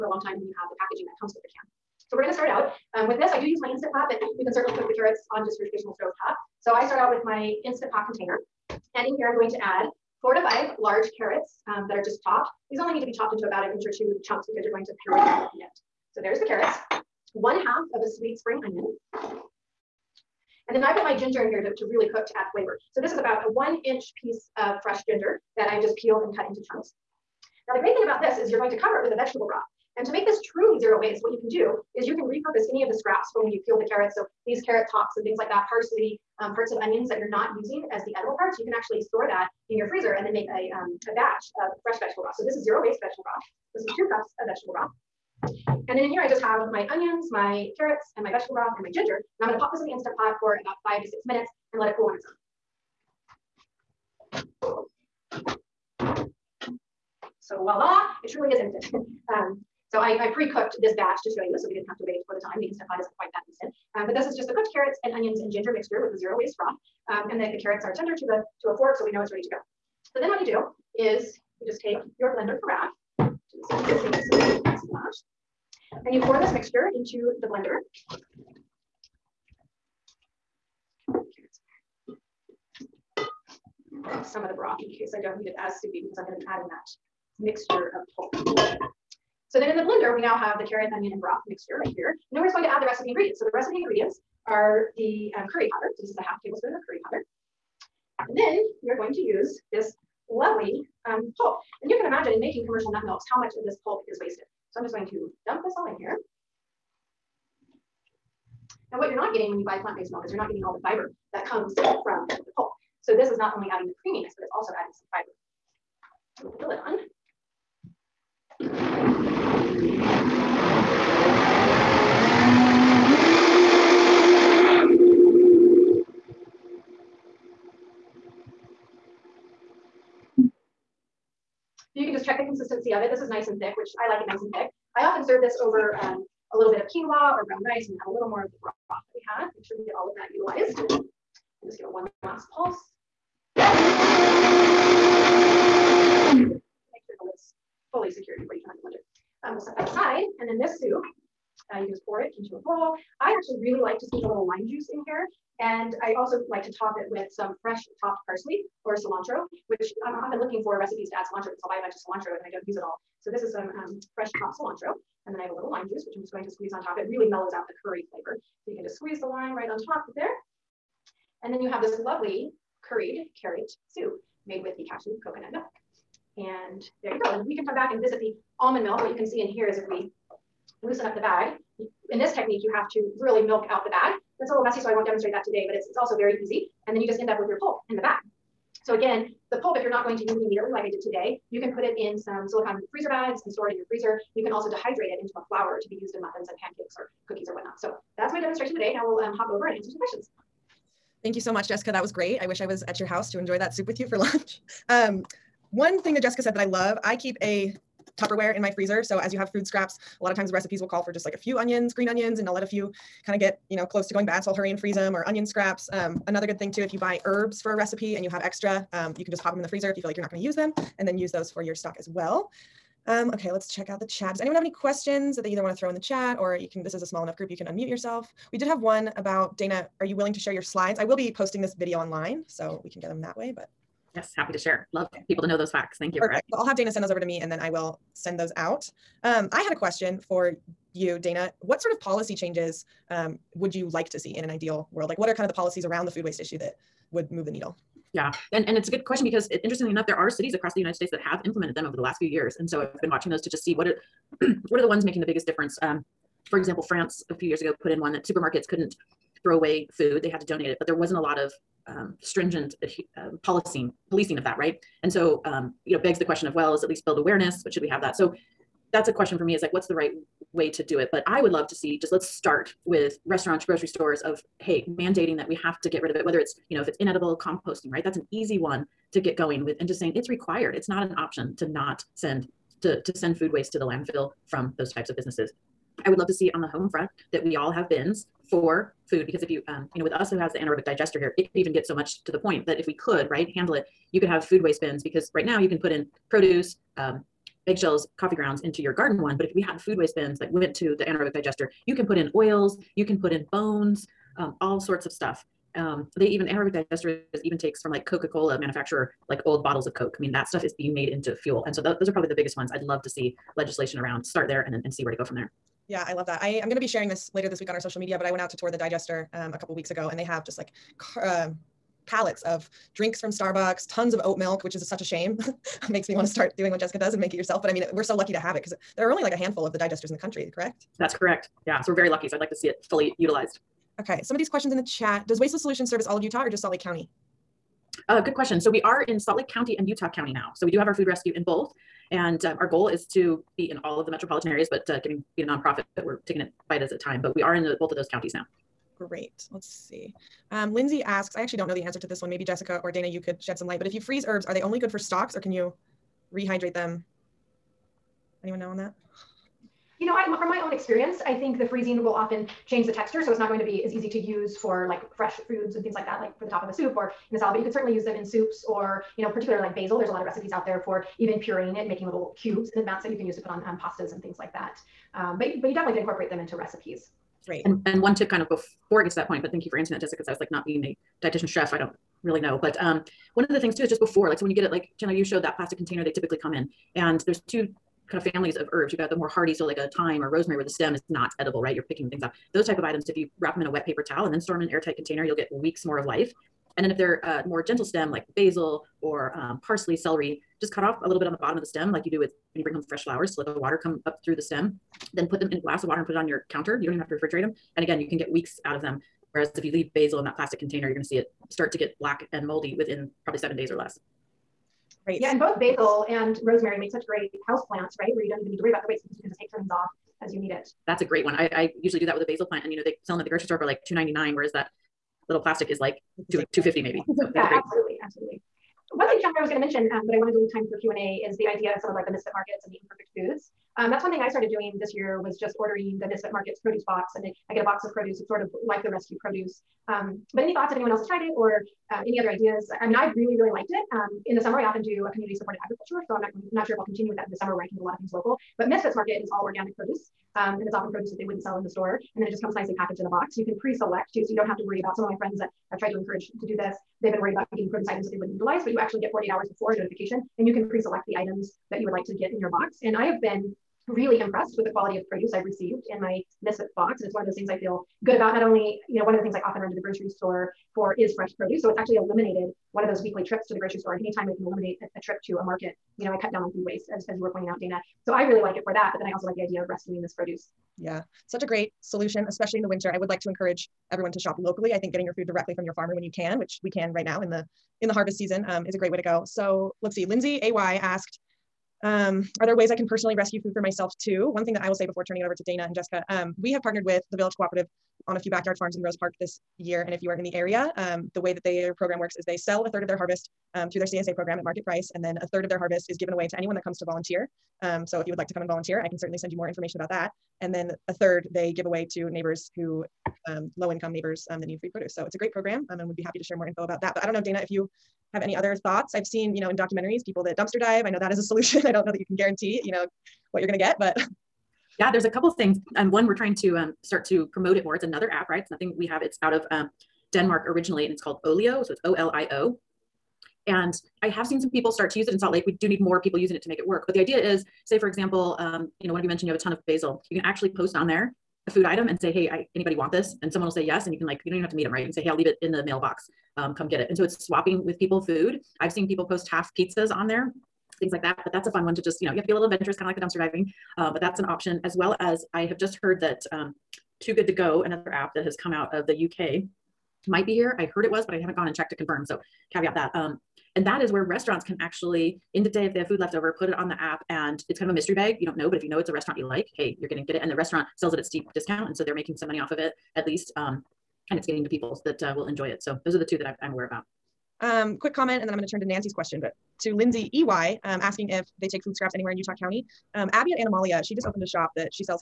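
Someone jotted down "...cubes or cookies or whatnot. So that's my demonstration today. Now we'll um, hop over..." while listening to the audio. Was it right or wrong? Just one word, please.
wrong.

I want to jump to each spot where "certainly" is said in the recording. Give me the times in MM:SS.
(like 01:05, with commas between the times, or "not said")
00:04, 06:07, 08:28.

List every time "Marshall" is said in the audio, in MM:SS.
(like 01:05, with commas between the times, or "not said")
not said.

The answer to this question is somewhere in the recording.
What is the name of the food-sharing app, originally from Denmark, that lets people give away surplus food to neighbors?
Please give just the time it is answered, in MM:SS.
08:51.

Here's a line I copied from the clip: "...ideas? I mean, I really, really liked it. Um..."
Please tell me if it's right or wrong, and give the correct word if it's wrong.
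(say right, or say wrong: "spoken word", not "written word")
right.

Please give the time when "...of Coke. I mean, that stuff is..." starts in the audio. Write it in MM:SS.
05:09.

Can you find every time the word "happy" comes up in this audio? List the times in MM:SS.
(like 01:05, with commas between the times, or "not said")
03:54, 08:36.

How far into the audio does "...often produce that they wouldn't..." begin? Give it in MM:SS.
07:30.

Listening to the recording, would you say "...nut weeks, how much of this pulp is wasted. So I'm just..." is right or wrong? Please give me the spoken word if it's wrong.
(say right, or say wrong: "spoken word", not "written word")
wrong: "milks", not "weeks".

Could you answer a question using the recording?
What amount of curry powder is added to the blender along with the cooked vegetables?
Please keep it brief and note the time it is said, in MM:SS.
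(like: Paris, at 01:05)
half tablespoon, at 01:36.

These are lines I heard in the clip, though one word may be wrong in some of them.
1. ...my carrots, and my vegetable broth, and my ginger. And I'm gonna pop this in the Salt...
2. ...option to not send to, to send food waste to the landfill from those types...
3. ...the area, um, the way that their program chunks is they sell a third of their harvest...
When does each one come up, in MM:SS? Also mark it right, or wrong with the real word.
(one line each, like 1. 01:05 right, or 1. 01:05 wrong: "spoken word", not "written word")
1. 00:47 wrong: "Instant", not "Salt"
2. 04:41 right
3. 08:20 wrong: "works", not "chunks".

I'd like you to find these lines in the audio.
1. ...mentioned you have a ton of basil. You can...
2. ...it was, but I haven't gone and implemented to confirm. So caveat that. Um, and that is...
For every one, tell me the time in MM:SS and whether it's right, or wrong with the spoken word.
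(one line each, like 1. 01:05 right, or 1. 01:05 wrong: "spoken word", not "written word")
1. 08:59 right
2. 09:20 wrong: "checked", not "implemented".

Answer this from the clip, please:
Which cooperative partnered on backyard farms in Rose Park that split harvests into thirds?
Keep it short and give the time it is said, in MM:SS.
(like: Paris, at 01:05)
Village Cooperative, at 08:17.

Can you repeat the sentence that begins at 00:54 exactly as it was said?
So voila, it truly is instant.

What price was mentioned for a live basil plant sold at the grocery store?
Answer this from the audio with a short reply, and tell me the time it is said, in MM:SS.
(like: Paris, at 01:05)
$2.99, at 07:03.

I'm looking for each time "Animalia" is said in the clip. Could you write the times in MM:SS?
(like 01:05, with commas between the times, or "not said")
09:43.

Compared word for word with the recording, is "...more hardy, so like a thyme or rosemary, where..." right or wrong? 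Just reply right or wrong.
right.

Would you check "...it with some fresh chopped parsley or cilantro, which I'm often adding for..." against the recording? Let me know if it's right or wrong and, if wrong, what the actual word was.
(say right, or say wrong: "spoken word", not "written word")
wrong: "looking", not "adding".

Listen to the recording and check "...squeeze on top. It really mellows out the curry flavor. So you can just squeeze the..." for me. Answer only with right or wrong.
right.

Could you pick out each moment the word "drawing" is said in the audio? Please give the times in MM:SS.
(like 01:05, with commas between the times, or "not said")
not said.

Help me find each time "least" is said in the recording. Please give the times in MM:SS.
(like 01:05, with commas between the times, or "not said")
04:26, 09:33.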